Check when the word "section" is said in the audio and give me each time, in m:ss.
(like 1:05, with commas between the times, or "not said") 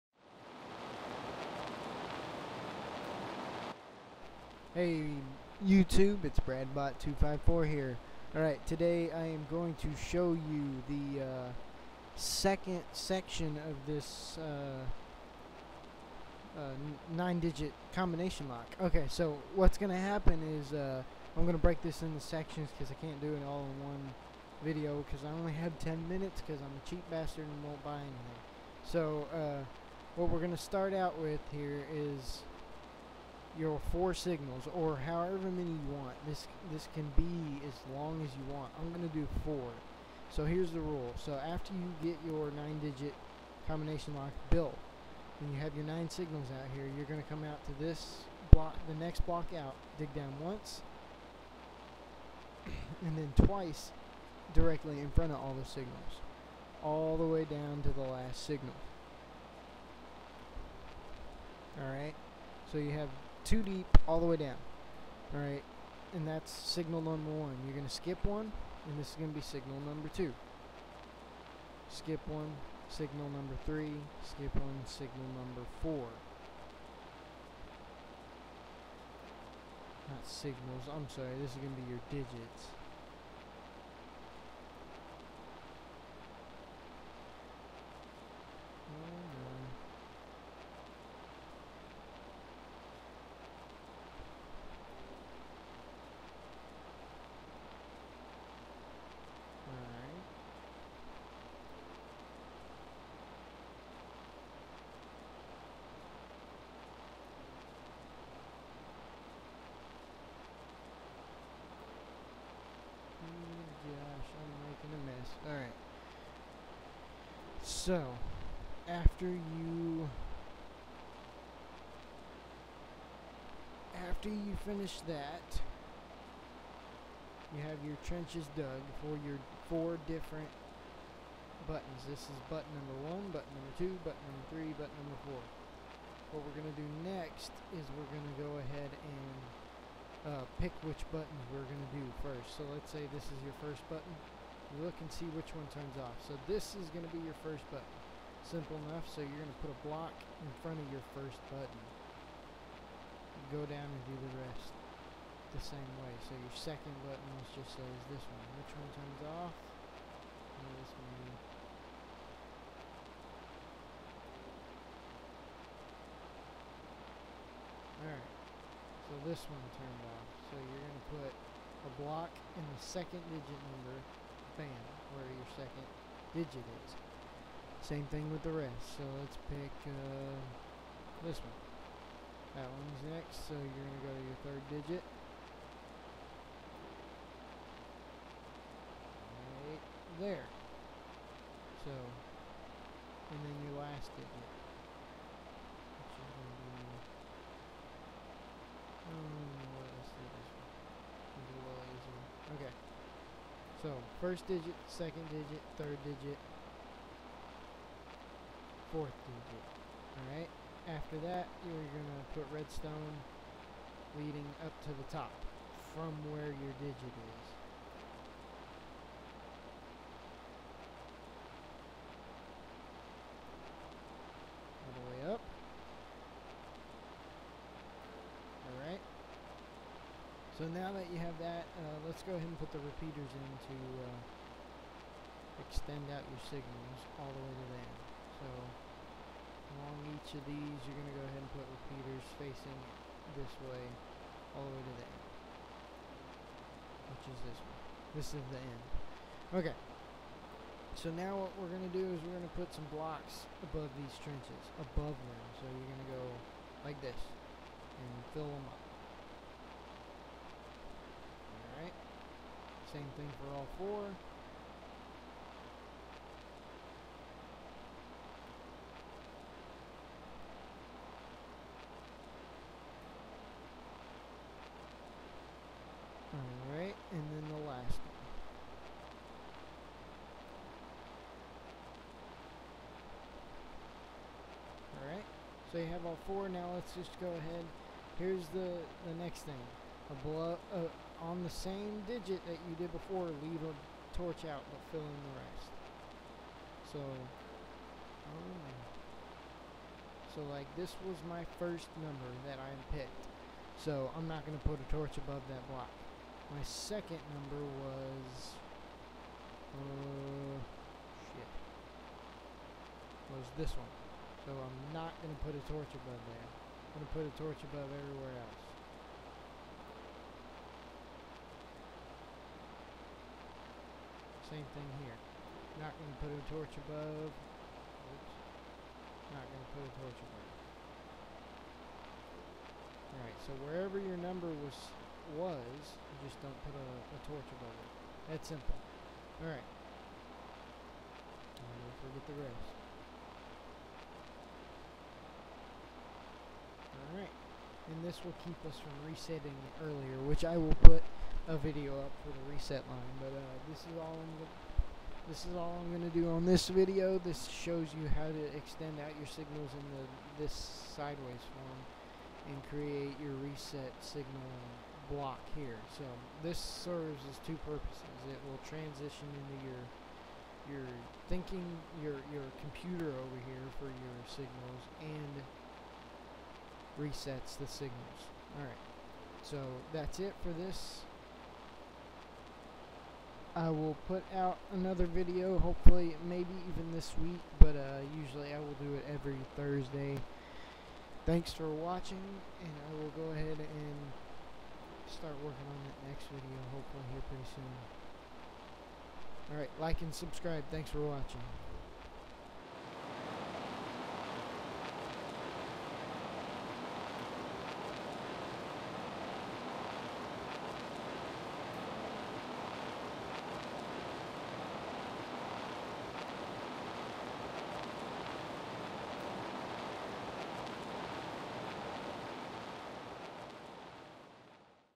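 0:12, 0:22.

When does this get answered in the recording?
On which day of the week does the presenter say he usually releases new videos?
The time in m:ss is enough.
6:29.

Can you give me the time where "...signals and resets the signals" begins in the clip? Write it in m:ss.
6:14.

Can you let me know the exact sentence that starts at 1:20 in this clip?
Not signals, I'm sorry, this is going to be your digits.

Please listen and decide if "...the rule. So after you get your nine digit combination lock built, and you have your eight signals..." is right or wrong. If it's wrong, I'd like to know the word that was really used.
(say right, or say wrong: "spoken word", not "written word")
wrong: "nine", not "eight".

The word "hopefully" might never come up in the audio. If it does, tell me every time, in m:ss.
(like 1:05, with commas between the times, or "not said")
6:25, 6:36.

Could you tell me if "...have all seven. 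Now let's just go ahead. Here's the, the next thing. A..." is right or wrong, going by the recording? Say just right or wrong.
wrong.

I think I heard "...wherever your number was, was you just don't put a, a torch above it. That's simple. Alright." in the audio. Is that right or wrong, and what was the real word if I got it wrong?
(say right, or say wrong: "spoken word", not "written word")
right.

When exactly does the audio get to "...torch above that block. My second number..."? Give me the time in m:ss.
5:04.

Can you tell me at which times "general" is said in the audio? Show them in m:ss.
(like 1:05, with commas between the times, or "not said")
not said.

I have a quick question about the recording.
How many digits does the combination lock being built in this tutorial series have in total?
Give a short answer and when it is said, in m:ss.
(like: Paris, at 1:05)
9, at 0:17.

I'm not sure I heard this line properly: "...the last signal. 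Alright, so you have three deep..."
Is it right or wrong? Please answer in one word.
wrong.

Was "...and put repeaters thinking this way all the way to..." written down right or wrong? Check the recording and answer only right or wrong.
wrong.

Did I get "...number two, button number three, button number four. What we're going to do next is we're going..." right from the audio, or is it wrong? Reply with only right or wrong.
right.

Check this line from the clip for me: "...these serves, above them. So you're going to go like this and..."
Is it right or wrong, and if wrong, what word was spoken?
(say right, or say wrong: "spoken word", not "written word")
wrong: "trenches", not "serves".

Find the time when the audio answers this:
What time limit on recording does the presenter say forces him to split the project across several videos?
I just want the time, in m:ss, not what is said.
0:25.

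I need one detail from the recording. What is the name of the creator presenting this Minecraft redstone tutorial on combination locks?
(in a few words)
BradBot254.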